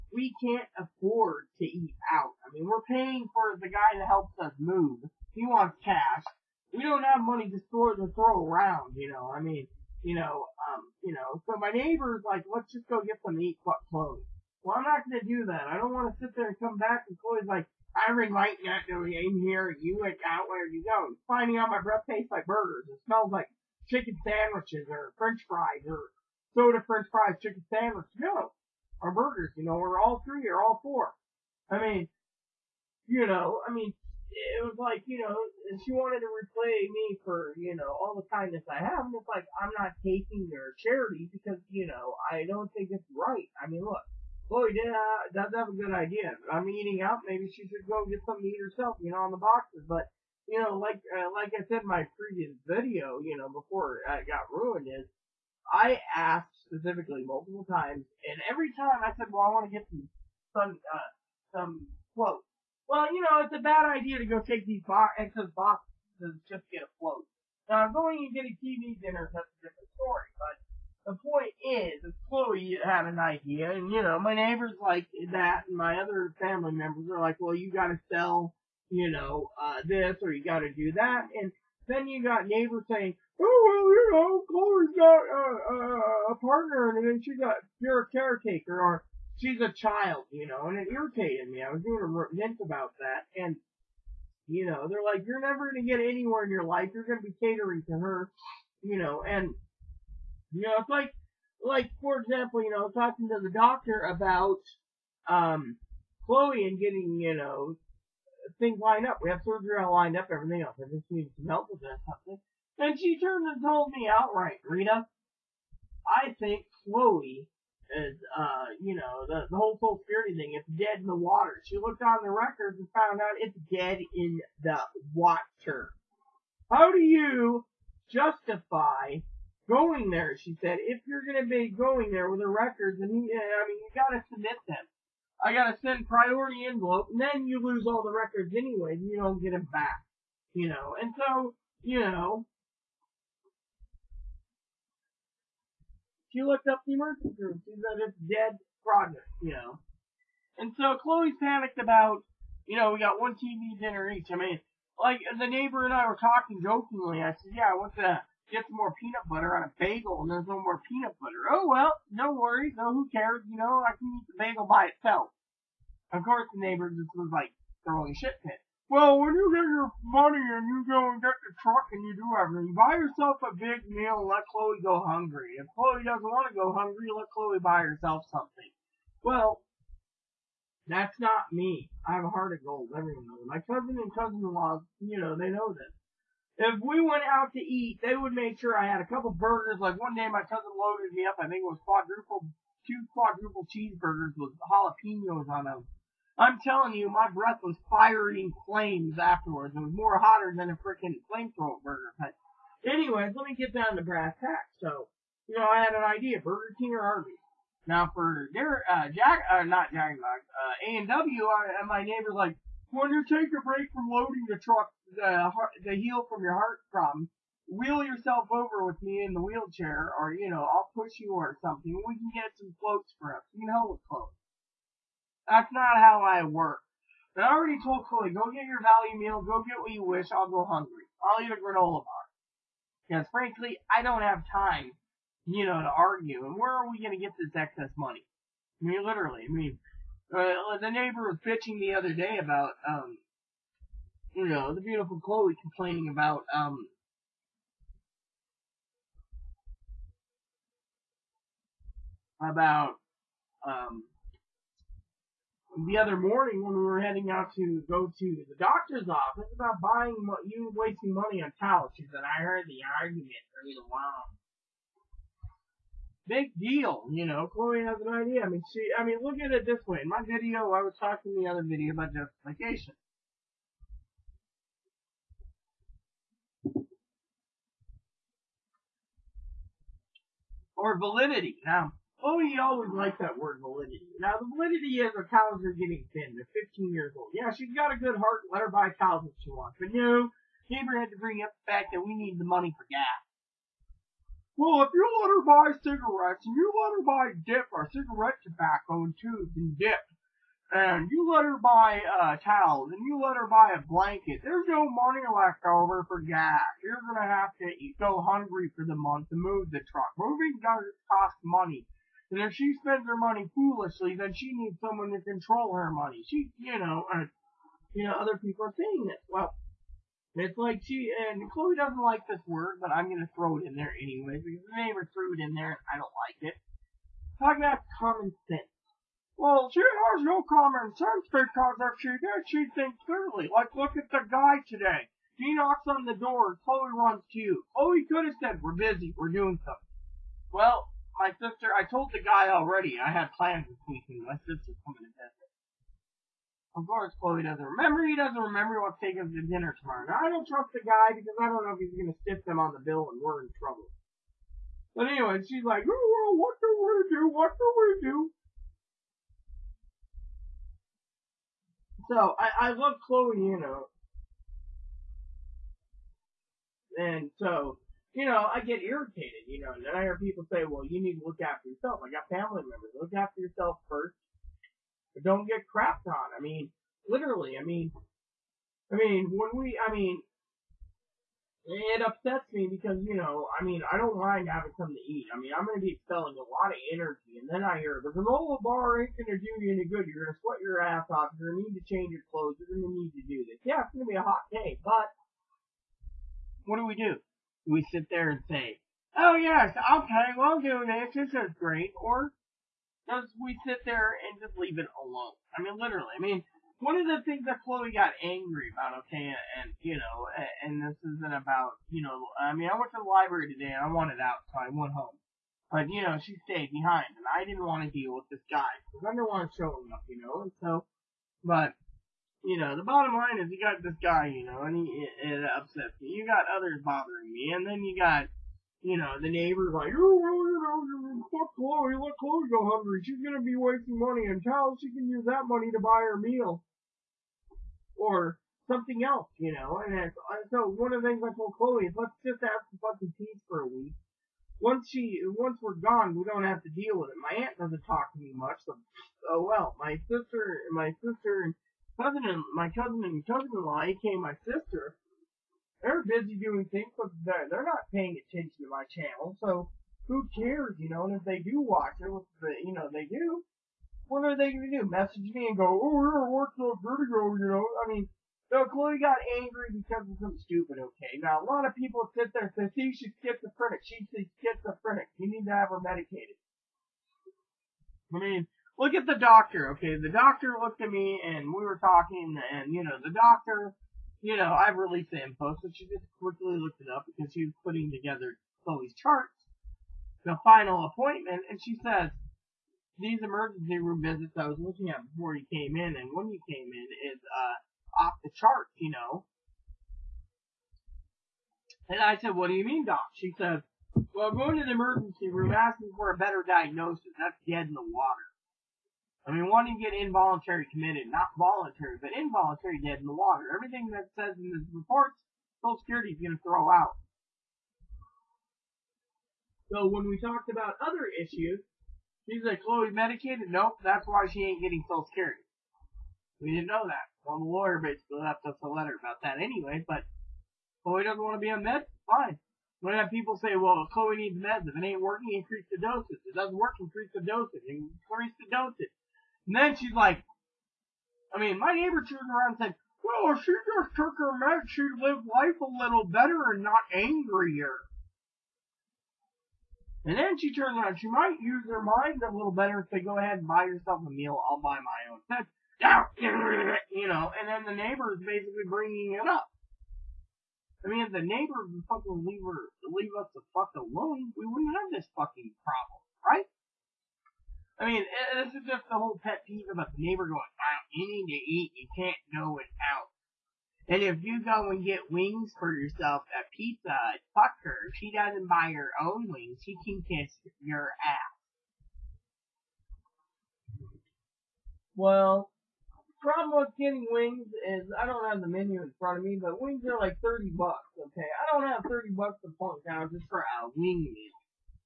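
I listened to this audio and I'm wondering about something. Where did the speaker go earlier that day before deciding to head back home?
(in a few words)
the library.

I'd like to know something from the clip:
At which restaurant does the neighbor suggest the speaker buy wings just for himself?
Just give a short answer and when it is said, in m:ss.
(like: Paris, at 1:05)
Pizza Hut, at 9:36.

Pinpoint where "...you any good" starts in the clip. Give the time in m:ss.
6:29.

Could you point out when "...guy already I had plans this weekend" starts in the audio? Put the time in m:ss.
5:42.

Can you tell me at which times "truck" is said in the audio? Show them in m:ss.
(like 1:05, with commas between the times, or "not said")
2:51, 3:34, 5:09.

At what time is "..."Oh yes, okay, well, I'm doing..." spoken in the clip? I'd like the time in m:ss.
6:39.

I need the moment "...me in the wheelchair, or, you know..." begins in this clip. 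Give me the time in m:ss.
3:39.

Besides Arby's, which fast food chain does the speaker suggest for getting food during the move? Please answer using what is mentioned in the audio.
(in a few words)
Burger King.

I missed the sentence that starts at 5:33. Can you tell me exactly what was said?
Like, look at the guy today.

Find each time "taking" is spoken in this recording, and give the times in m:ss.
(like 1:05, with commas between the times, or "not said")
0:40, 5:49.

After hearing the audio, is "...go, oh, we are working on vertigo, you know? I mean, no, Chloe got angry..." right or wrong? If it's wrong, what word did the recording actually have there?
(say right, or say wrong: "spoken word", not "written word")
right.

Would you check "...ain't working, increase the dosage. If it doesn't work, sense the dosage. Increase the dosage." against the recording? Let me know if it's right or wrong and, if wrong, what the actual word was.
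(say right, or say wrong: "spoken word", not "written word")
wrong: "increase", not "sense".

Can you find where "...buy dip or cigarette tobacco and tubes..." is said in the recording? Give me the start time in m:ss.
4:57.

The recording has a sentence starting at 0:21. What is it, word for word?
Finding out my breath tastes like burgers.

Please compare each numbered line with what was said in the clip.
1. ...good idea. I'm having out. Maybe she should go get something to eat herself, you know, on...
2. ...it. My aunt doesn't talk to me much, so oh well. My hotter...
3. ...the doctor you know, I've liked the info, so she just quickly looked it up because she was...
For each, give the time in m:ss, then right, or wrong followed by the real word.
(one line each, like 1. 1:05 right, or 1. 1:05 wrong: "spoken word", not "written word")
1. 0:45 wrong: "eating", not "having"
2. 7:27 wrong: "sister", not "hotter"
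3. 8:02 wrong: "released", not "liked".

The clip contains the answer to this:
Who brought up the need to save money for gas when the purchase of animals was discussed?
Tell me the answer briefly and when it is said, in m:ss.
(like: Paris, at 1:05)
Gabriel, at 4:50.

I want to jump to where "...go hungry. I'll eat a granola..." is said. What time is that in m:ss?
3:50.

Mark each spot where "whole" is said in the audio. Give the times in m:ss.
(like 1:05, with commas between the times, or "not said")
1:59, 9:28.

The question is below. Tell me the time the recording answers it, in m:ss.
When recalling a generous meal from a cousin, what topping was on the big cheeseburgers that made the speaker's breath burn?
3:14.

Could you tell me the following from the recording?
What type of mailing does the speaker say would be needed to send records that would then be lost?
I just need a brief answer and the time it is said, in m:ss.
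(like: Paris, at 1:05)
priority envelope, at 2:16.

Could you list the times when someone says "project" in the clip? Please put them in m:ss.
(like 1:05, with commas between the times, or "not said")
2:28.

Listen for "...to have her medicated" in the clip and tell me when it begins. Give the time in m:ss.
7:55.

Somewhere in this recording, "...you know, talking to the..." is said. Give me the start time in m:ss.
1:42.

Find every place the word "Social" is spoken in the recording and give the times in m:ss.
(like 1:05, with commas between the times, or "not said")
1:59, 8:35, 8:44.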